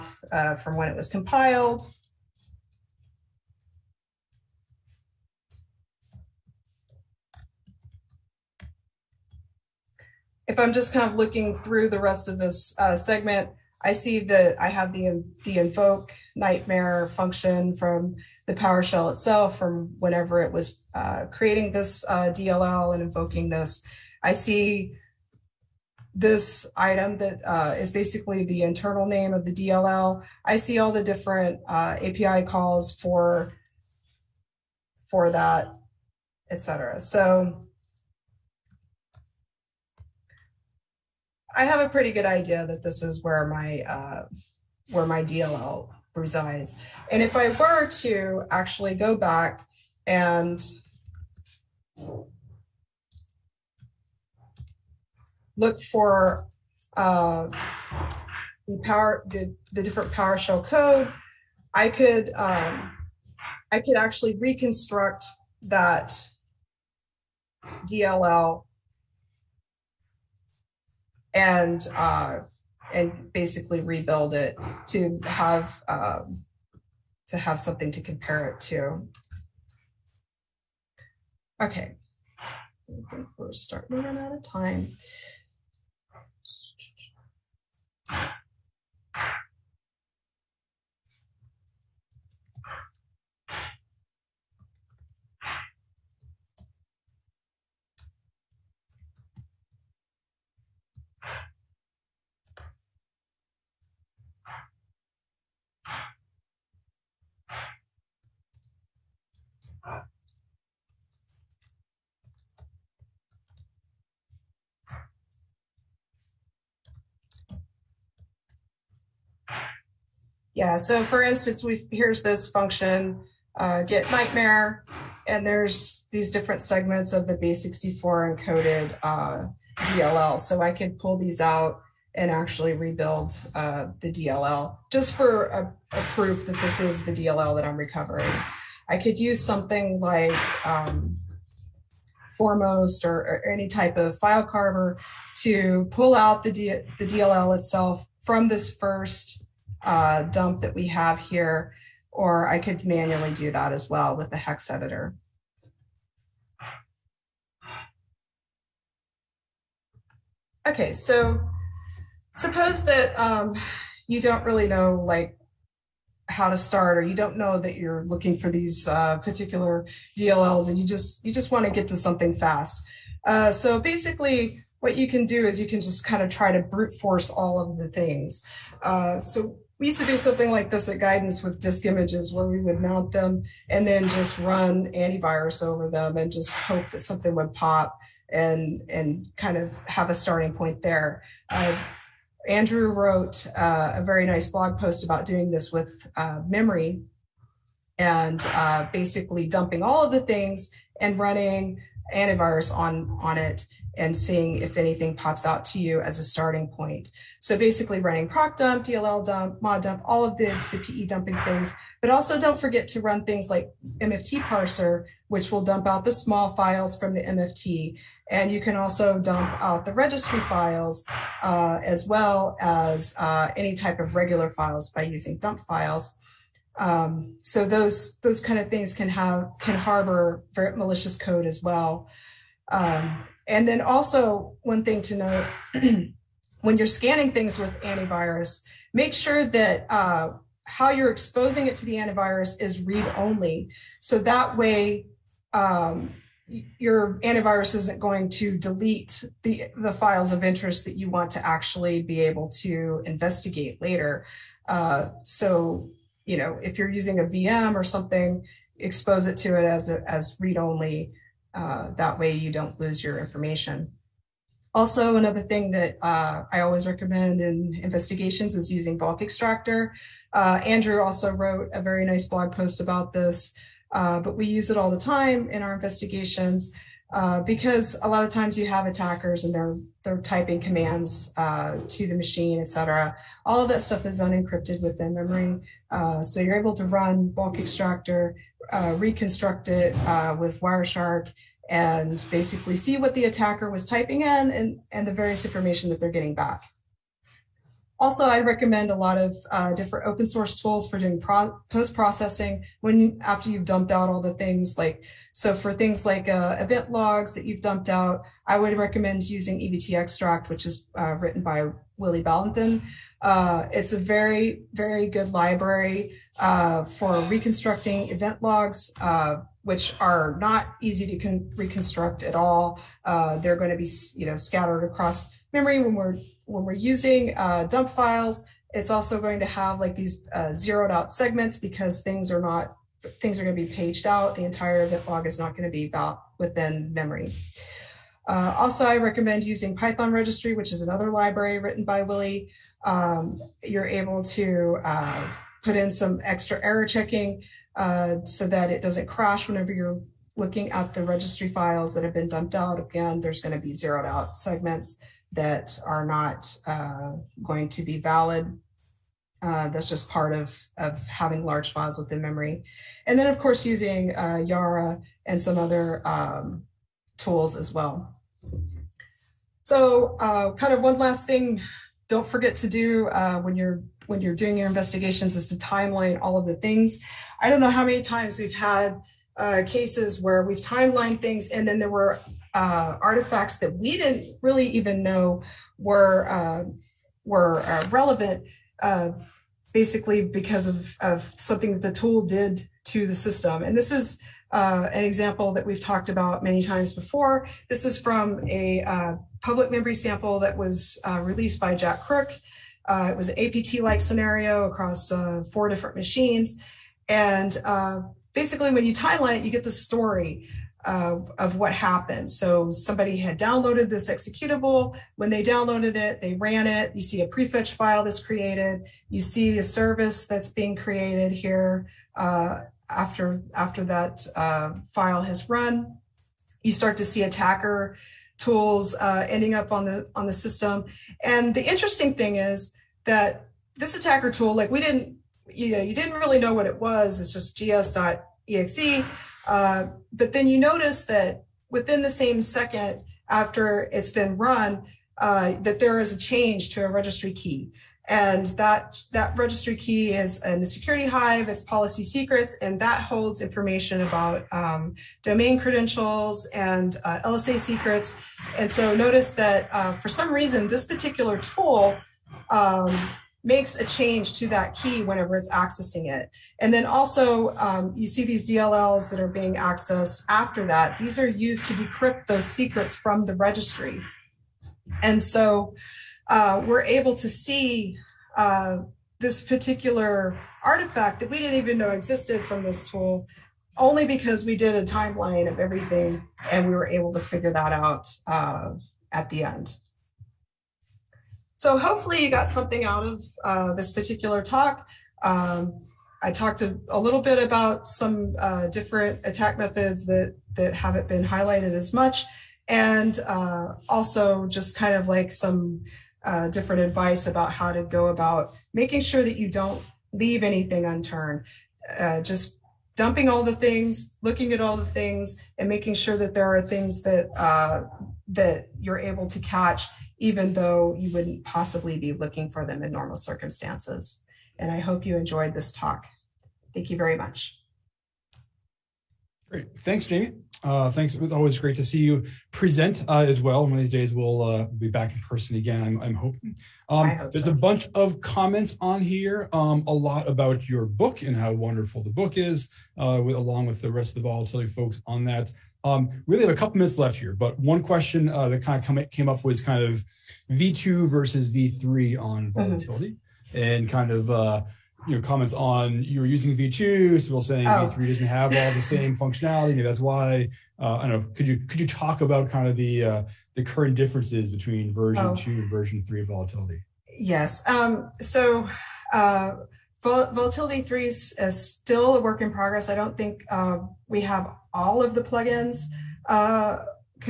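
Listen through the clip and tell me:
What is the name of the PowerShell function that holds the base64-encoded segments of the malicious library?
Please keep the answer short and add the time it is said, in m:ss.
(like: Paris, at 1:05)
get nightmare, at 2:03.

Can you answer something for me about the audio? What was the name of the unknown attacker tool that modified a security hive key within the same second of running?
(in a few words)
gs.exe.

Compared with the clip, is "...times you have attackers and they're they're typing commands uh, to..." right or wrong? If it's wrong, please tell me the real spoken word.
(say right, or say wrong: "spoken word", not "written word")
right.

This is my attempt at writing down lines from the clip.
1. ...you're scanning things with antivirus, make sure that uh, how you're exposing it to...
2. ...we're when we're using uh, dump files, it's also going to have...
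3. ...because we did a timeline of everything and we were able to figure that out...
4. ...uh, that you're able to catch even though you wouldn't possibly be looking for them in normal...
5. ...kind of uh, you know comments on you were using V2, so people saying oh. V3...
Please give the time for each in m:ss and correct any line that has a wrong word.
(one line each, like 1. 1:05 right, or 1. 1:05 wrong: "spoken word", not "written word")
1. 3:56 right
2. 5:25 right
3. 8:04 right
4. 8:37 right
5. 9:13 right.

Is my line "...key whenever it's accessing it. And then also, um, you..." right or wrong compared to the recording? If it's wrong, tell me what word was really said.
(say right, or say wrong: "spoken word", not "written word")
right.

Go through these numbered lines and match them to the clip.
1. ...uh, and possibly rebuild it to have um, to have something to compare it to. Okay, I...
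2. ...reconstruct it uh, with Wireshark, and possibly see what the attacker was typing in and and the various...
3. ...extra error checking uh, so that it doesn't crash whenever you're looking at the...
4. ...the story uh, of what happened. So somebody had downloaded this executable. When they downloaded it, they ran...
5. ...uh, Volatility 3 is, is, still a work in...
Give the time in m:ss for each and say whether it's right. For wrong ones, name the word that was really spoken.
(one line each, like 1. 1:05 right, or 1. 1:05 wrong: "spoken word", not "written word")
1. 1:11 wrong: "basically", not "possibly"
2. 4:48 wrong: "basically", not "possibly"
3. 5:46 right
4. 6:49 right
5. 9:29 right.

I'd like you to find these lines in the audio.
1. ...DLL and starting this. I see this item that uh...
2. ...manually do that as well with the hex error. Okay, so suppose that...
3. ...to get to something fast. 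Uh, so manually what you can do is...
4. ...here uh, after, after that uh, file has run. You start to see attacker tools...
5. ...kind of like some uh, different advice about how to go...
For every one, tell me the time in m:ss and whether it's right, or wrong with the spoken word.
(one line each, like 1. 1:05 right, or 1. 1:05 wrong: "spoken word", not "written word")
1. 0:22 wrong: "invoking", not "starting"
2. 2:32 wrong: "editor", not "error"
3. 2:51 wrong: "basically", not "manually"
4. 7:01 right
5. 8:24 right.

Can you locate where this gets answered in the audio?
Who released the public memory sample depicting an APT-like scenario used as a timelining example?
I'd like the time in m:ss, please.
6:41.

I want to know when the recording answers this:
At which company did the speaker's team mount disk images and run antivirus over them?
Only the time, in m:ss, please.
3:00.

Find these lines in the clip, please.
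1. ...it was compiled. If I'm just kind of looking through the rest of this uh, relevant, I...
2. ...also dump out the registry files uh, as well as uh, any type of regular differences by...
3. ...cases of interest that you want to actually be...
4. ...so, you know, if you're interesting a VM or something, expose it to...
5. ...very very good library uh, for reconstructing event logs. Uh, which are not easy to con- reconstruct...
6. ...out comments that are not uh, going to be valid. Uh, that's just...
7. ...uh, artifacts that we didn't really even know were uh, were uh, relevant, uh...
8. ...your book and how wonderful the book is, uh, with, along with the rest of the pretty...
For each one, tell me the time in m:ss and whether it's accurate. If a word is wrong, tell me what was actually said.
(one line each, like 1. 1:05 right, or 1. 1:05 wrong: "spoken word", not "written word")
1. 0:00 wrong: "segment", not "relevant"
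2. 3:38 wrong: "files", not "differences"
3. 4:09 wrong: "files", not "cases"
4. 4:15 wrong: "using", not "interesting"
5. 5:13 right
6. 5:54 wrong: "segments", not "comments"
7. 6:22 right
8. 9:00 wrong: "volatility", not "pretty".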